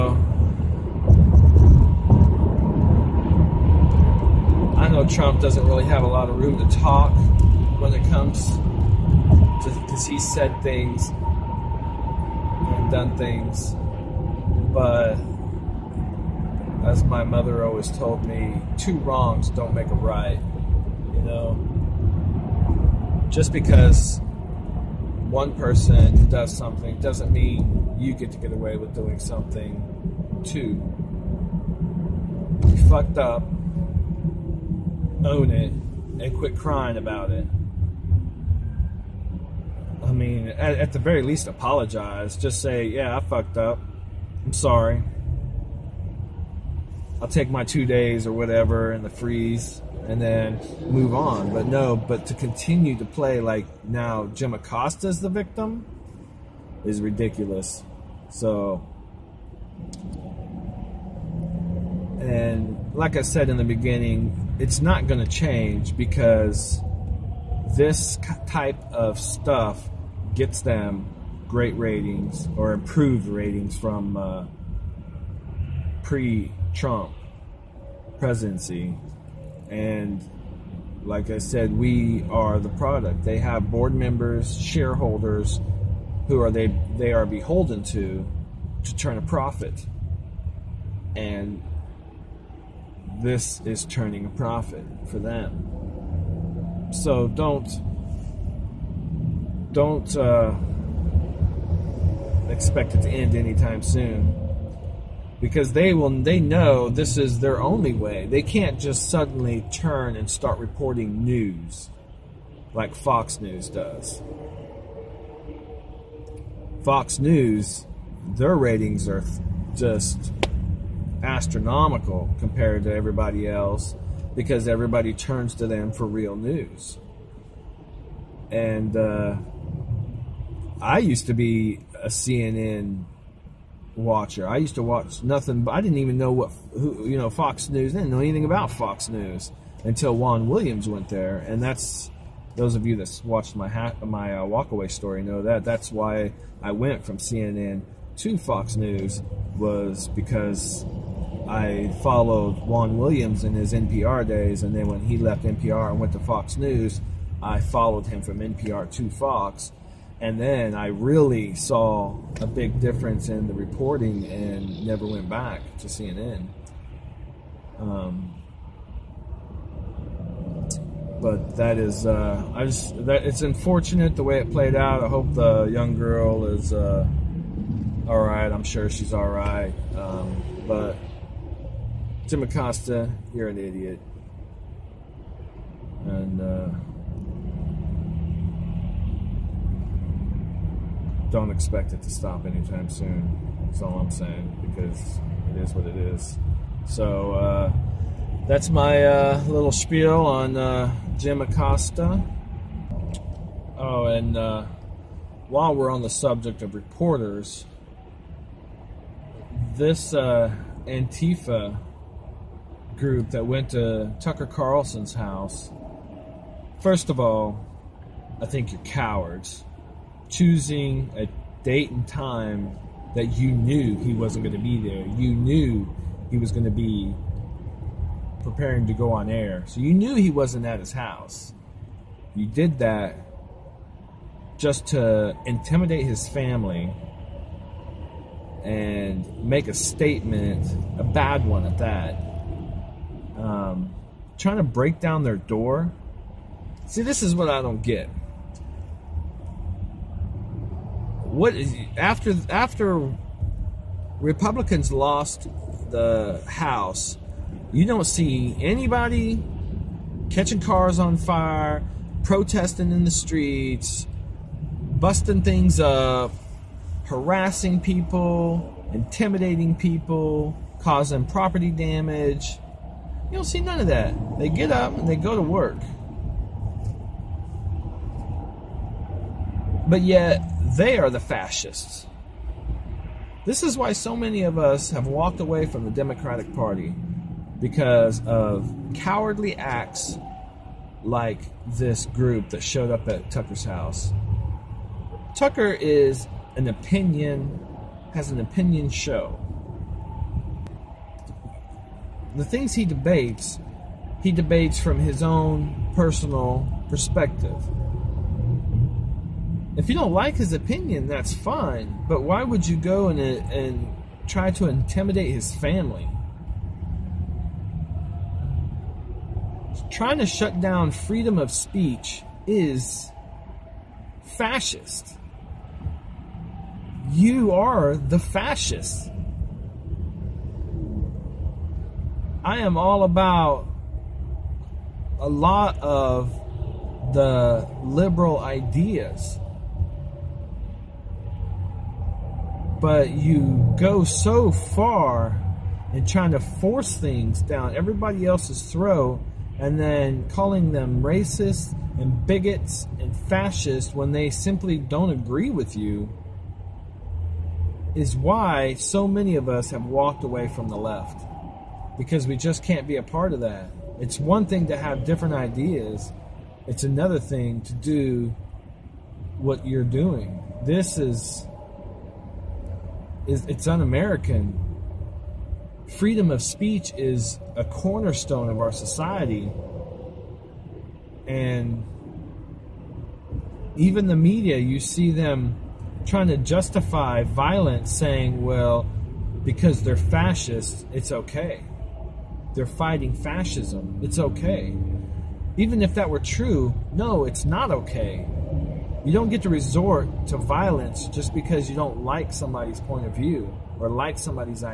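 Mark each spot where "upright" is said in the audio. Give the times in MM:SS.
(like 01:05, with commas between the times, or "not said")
not said.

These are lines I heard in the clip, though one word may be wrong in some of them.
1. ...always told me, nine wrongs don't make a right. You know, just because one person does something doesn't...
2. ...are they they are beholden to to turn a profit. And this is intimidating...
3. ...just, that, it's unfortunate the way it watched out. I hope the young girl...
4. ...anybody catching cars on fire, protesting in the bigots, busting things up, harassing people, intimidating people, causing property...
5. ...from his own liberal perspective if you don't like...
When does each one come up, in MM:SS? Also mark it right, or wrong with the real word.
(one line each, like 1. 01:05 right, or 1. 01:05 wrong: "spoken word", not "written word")
1. 00:17 wrong: "two", not "nine"
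2. 01:26 wrong: "turning", not "intimidating"
3. 02:52 wrong: "played", not "watched"
4. 04:18 wrong: "streets", not "bigots"
5. 05:04 wrong: "personal", not "liberal".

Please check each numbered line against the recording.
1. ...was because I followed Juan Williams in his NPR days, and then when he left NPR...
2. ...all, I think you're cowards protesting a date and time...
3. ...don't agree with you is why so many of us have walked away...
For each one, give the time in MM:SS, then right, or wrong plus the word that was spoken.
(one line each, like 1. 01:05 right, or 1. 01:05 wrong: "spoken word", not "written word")
1. 02:29 right
2. 03:37 wrong: "choosing", not "protesting"
3. 05:54 right.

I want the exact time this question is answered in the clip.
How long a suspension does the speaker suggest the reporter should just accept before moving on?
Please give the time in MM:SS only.
00:47.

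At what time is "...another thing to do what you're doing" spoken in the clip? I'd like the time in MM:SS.
06:06.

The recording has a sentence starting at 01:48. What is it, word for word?
They can't just suddenly turn and start reporting news like Fox News does.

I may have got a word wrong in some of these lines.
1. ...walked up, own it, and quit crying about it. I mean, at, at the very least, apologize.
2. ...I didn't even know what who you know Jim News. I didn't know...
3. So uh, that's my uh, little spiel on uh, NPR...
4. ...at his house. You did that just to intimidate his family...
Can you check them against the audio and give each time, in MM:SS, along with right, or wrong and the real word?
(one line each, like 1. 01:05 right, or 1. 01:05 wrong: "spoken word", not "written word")
1. 00:32 wrong: "fucked", not "walked"
2. 02:15 wrong: "Fox", not "Jim"
3. 03:16 wrong: "Jim", not "NPR"
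4. 03:50 right.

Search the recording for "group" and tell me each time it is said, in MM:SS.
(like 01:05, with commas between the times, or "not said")
03:32, 04:52.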